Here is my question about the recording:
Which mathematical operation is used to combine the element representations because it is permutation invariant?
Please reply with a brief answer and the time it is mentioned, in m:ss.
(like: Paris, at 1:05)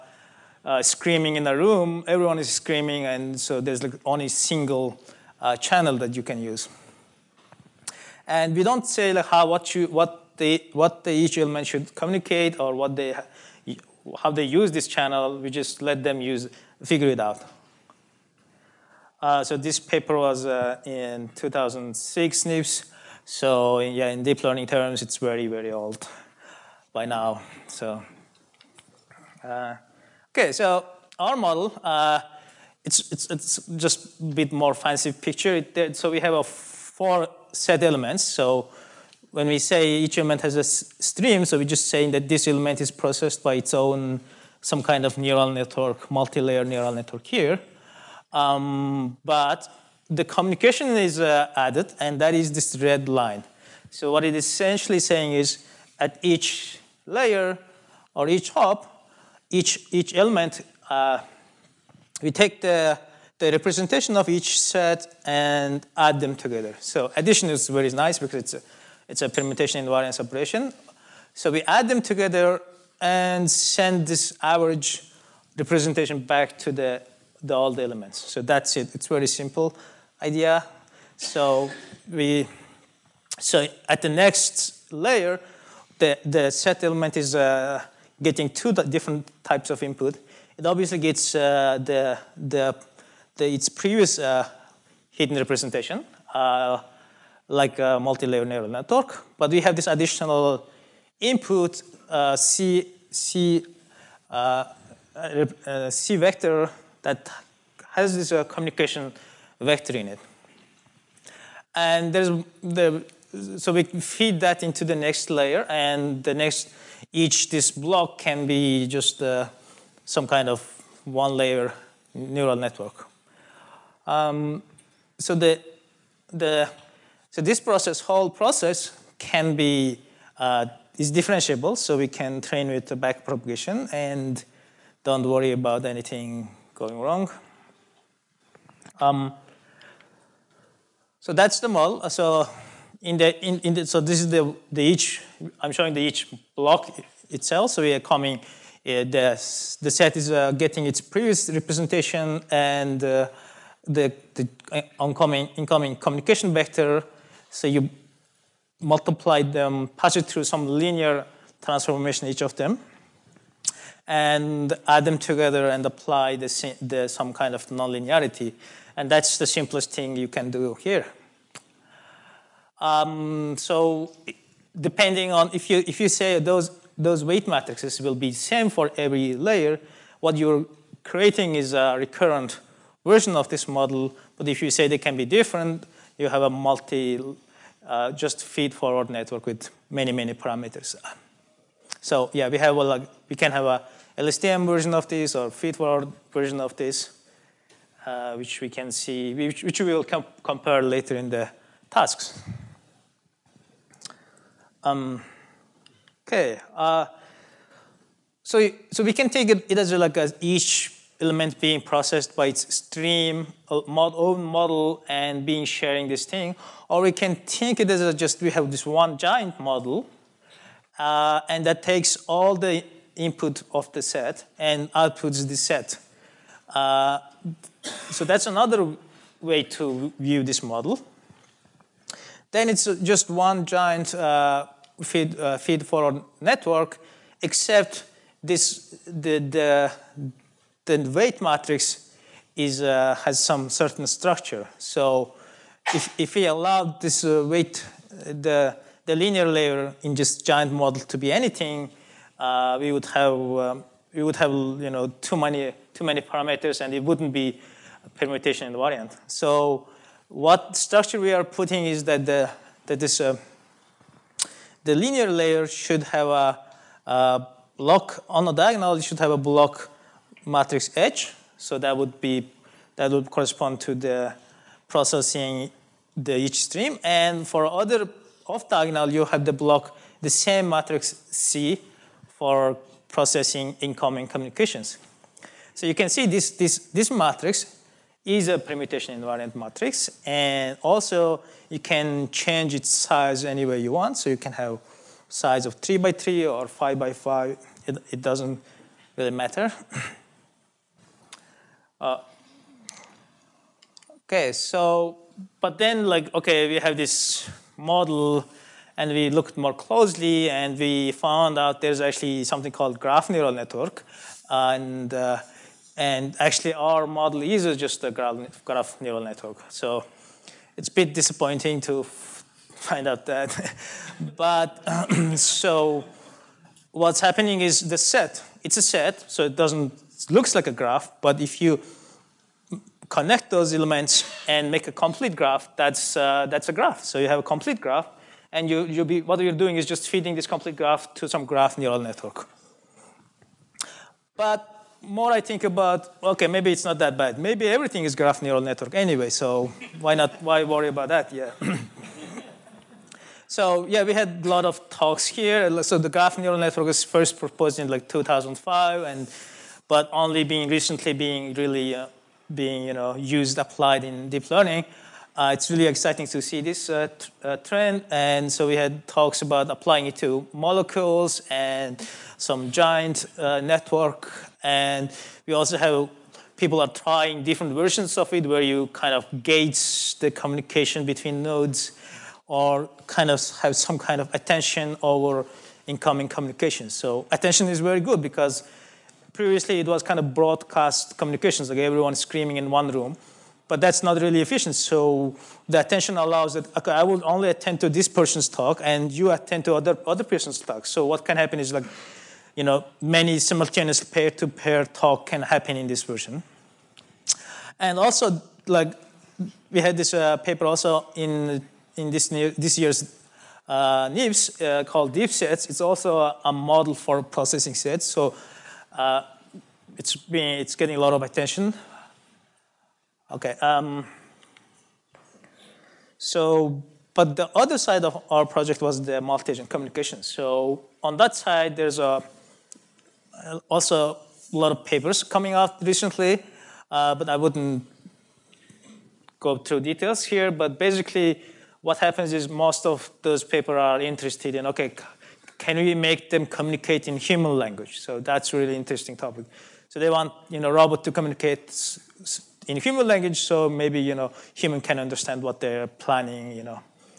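Addition, at 1:07.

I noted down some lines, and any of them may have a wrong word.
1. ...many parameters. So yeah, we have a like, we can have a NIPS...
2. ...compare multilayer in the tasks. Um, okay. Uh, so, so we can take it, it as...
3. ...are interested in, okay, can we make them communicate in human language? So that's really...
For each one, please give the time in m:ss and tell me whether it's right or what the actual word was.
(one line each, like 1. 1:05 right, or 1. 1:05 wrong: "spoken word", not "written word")
1. 3:10 wrong: "LSTM", not "NIPS"
2. 3:20 wrong: "later", not "multilayer"
3. 7:23 right.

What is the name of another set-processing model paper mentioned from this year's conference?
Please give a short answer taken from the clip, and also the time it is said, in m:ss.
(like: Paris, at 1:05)
Deep sets, at 6:55.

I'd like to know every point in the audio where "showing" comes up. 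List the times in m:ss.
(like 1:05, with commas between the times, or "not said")
2:25.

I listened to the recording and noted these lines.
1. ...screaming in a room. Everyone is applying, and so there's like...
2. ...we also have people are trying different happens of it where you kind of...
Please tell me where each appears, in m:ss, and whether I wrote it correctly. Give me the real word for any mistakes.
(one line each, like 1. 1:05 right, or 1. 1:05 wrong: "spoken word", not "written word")
1. 0:00 wrong: "screaming", not "applying"
2. 6:15 wrong: "versions", not "happens".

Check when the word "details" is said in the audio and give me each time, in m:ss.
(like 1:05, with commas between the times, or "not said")
7:19.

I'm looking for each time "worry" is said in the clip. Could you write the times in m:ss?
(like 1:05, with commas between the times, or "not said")
2:15, 5:50.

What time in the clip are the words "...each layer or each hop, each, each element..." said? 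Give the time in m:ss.
0:56.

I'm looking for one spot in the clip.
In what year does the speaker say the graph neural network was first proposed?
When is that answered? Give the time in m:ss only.
5:58.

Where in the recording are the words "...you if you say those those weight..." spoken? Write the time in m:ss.
2:55.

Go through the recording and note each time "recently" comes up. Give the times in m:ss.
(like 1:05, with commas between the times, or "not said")
6:00, 7:15.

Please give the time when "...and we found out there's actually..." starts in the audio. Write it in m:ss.
5:10.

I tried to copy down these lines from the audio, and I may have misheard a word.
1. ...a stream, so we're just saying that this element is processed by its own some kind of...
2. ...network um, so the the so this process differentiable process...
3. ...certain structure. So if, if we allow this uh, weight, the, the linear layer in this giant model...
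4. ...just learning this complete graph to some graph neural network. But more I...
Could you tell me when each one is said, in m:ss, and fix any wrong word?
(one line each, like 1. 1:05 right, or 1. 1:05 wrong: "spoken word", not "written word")
1. 0:40 right
2. 2:02 wrong: "whole", not "differentiable"
3. 4:03 right
4. 5:39 wrong: "feeding", not "learning".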